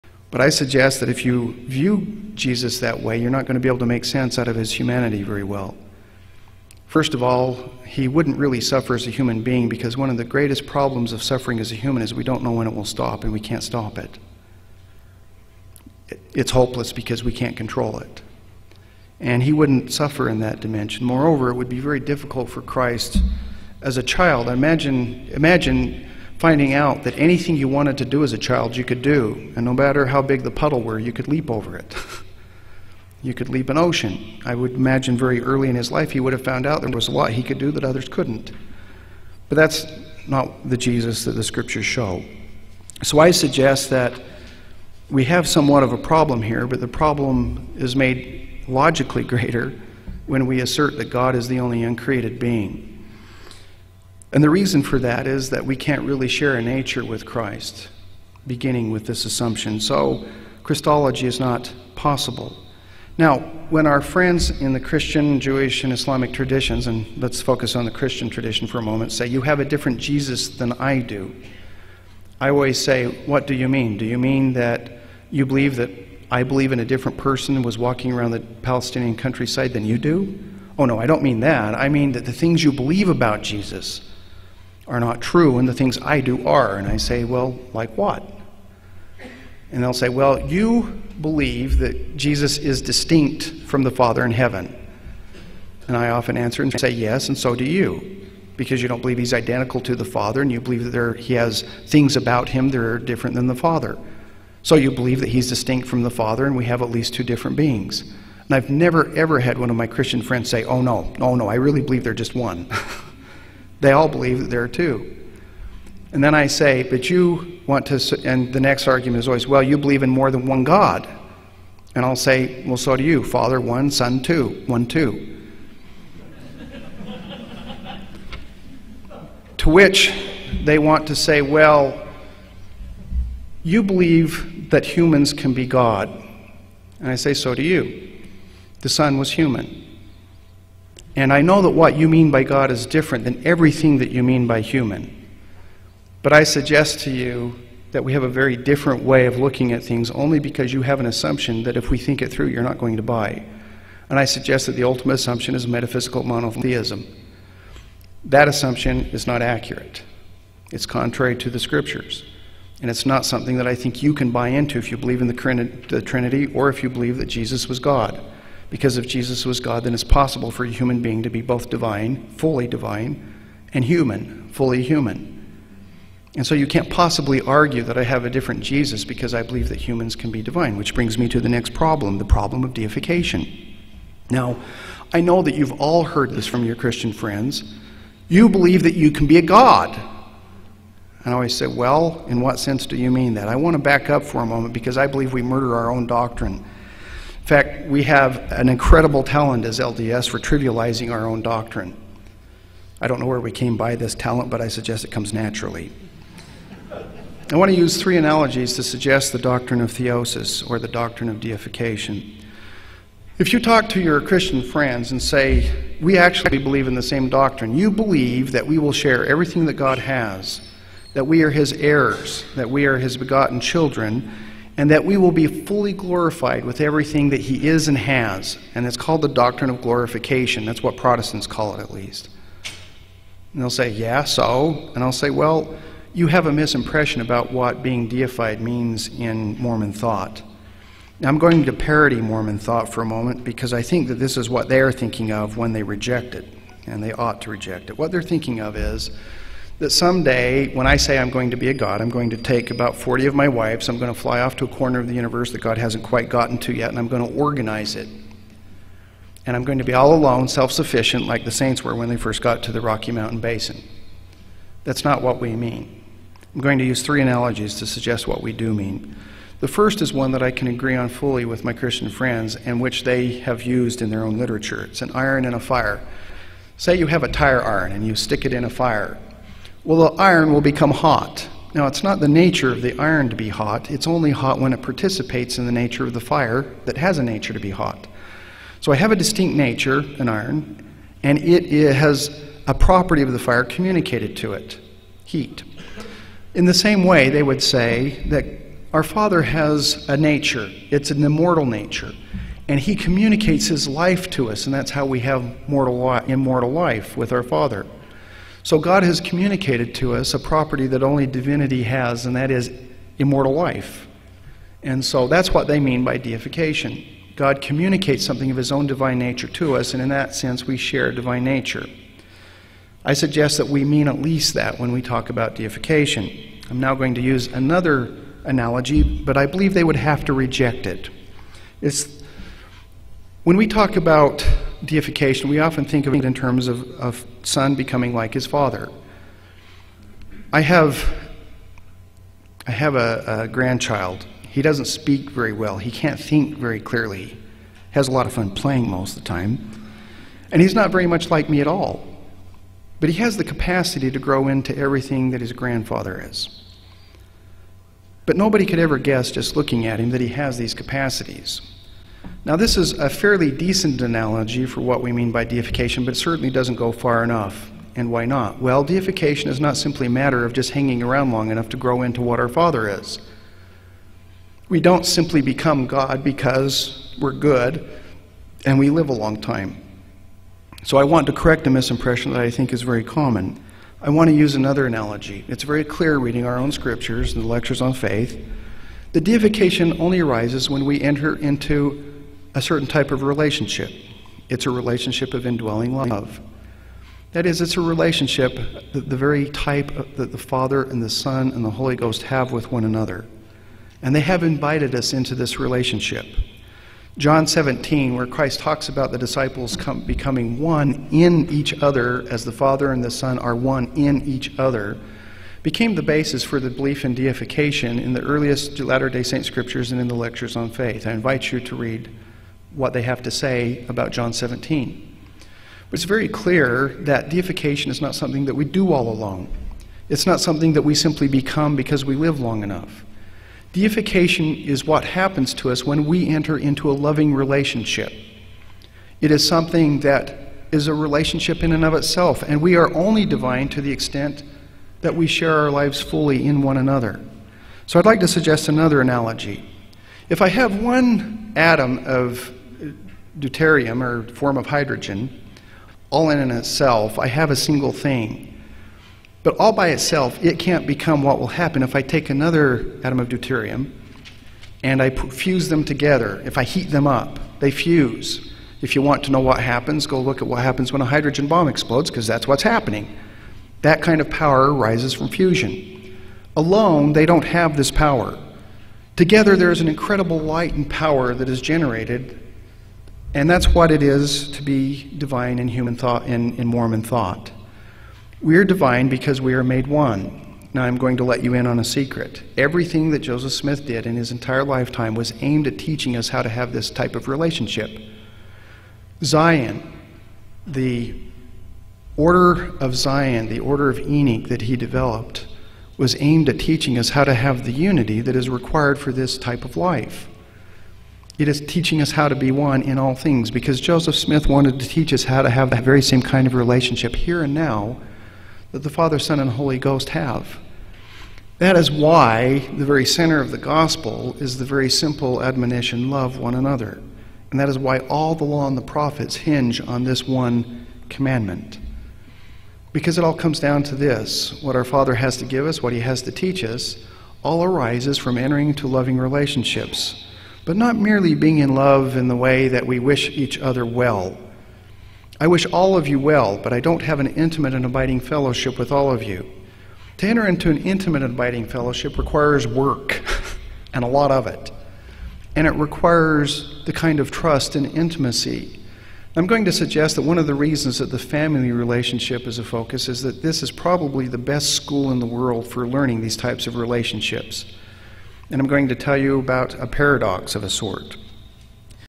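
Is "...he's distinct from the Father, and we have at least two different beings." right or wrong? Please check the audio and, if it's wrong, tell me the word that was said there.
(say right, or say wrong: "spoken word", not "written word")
right.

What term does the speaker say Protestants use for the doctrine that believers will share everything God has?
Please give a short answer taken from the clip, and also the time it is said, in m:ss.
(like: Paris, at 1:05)
Glorification, at 3:49.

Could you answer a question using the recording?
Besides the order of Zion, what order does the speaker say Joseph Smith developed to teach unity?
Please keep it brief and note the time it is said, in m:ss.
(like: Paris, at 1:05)
The order of Enoch, at 8:23.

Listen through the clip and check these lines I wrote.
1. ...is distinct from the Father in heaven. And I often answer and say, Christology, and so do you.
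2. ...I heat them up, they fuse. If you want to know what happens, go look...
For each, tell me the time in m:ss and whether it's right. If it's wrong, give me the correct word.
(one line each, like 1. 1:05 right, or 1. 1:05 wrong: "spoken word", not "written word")
1. 1:32 wrong: "Yes", not "Christology"
2. 7:46 right.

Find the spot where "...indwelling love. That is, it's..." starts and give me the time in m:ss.
6:35.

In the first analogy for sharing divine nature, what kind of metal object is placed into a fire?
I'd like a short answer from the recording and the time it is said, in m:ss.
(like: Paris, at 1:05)
A tire iron, at 4:37.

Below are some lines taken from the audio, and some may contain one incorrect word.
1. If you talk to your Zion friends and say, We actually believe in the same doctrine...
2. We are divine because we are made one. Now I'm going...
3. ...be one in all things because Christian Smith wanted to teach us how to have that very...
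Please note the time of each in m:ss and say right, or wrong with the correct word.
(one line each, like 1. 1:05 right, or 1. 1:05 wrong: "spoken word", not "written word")
1. 3:33 wrong: "Christian", not "Zion"
2. 8:08 right
3. 8:32 wrong: "Joseph", not "Christian".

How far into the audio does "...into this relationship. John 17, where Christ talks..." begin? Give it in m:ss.
6:45.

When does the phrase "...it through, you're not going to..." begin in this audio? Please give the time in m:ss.
2:32.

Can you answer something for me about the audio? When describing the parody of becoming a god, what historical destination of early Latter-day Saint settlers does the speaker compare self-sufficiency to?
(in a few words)
Rocky Mountain Basin.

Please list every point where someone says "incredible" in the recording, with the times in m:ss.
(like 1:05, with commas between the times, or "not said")
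3:18, 7:59.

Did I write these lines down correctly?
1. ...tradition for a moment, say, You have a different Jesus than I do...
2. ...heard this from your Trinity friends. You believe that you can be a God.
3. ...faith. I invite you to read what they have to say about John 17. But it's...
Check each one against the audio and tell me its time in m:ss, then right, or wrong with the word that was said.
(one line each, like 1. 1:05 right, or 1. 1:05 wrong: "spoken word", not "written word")
1. 1:08 right
2. 3:06 wrong: "Christian", not "Trinity"
3. 7:00 right.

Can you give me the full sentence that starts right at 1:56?
And then I say, but you want to, and the next argument is always, well, you believe in more than one God.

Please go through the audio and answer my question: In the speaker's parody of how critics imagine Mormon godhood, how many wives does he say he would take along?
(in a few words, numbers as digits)
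40.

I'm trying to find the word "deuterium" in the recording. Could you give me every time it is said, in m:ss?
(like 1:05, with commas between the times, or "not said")
7:33, 7:43.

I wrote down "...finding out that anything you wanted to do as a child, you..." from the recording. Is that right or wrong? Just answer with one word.
right.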